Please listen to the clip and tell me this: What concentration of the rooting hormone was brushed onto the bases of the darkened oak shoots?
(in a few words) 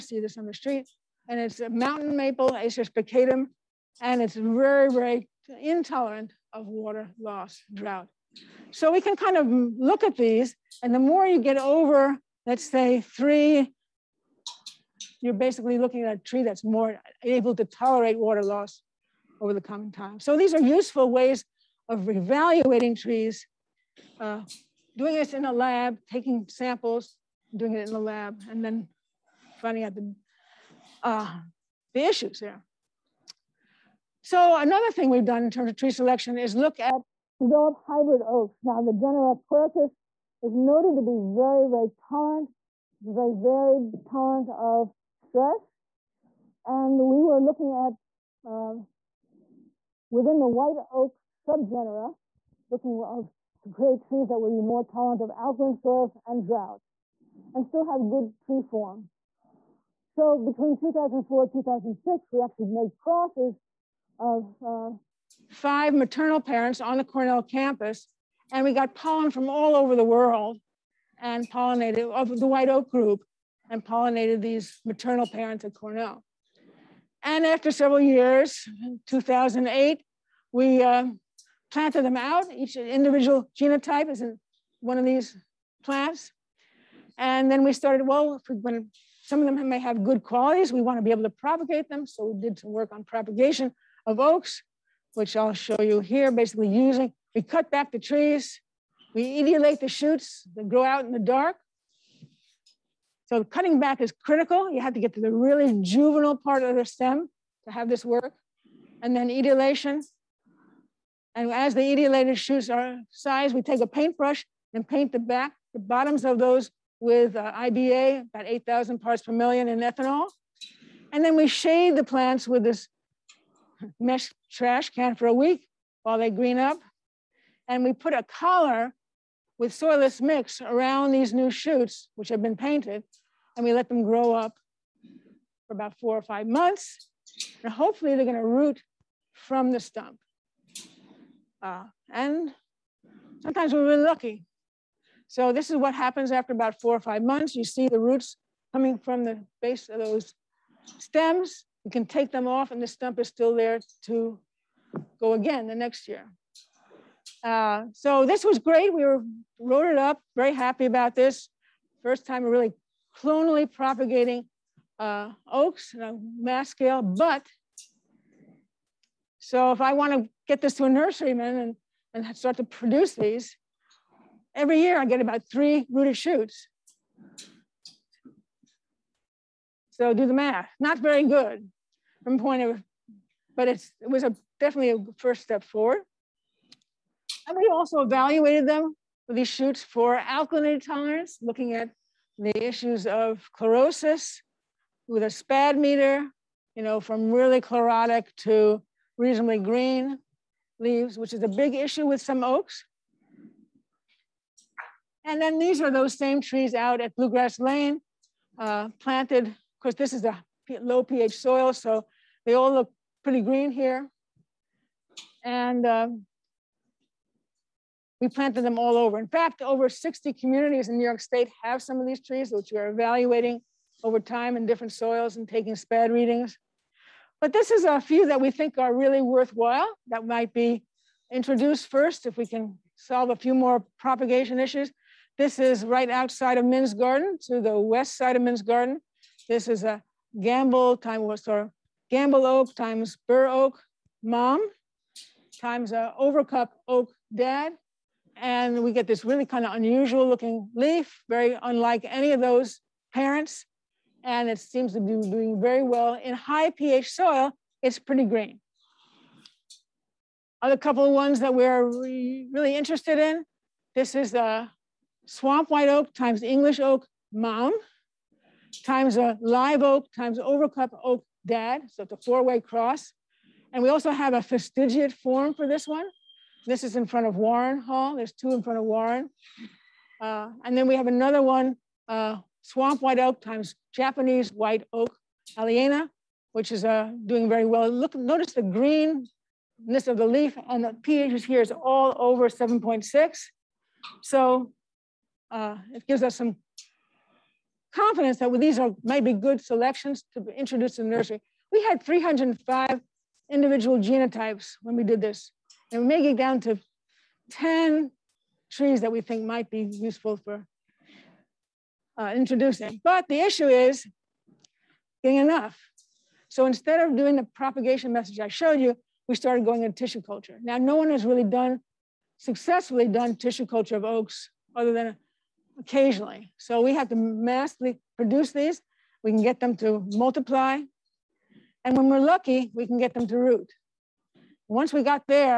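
8,000 parts per million.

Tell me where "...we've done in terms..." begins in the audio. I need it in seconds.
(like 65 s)
35 s.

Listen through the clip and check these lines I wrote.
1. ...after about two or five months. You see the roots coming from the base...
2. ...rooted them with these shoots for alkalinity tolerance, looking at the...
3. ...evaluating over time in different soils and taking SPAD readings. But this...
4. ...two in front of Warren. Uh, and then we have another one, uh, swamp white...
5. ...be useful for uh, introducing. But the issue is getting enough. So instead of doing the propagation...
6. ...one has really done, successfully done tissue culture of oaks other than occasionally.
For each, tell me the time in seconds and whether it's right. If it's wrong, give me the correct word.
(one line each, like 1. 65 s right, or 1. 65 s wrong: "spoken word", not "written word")
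1. 146 s wrong: "four", not "two"
2. 187 s wrong: "evaluated", not "rooted"
3. 222 s right
4. 278 s right
5. 309 s right
6. 320 s right.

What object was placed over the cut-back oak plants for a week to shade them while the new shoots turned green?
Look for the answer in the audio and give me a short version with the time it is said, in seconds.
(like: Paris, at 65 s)
mesh trash can, at 123 s.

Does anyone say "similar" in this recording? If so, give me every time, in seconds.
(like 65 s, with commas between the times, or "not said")
not said.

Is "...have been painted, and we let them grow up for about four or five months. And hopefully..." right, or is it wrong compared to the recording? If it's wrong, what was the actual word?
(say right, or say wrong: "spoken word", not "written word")
right.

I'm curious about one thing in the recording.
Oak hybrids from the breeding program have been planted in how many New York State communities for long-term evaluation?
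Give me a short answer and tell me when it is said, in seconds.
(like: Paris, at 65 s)
over 60, at 219 s.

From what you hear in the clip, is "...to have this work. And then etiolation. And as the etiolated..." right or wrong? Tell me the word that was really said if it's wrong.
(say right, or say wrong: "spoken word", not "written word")
right.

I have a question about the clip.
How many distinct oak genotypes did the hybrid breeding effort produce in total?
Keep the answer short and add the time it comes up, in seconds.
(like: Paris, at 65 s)
305, at 302 s.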